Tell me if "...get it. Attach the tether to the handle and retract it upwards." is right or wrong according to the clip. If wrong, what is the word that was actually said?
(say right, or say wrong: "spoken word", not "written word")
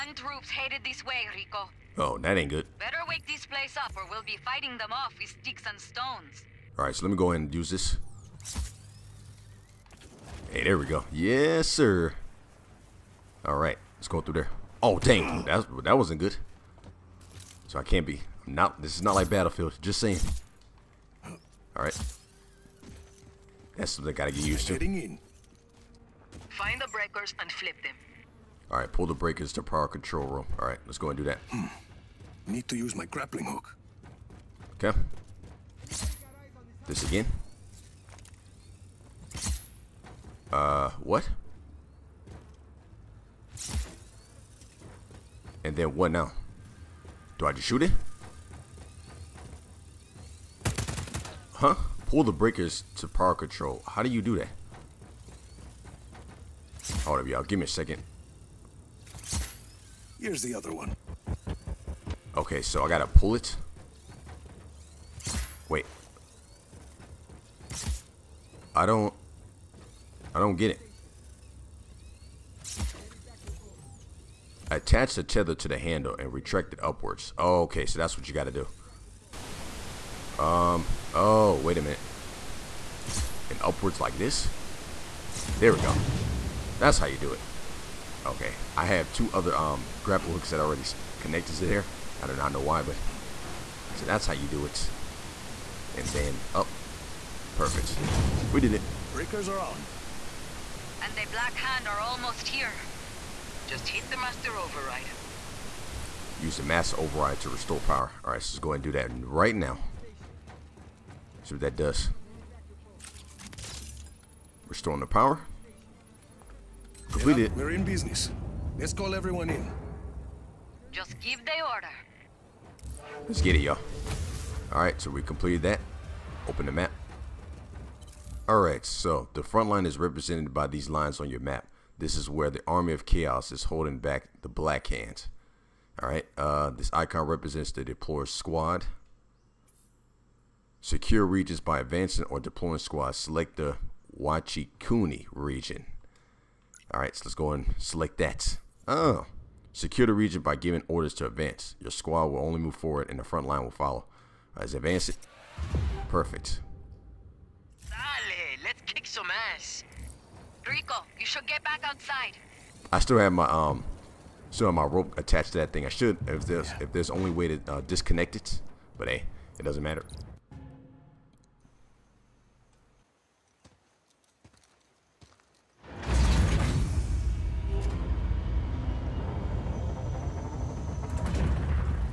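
right.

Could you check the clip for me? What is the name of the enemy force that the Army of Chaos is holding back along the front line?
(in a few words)
Black Hands.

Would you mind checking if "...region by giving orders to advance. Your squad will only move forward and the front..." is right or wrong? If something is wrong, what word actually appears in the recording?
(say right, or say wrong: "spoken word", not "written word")
right.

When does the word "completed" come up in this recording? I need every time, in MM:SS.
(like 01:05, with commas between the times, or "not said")
01:57, 02:05.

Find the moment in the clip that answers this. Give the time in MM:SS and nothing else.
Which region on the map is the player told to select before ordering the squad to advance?
02:24.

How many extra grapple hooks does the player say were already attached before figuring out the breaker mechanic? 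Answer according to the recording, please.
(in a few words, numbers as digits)
2.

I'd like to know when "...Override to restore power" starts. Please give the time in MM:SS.
01:46.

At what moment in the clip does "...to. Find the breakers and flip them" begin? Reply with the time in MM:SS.
00:24.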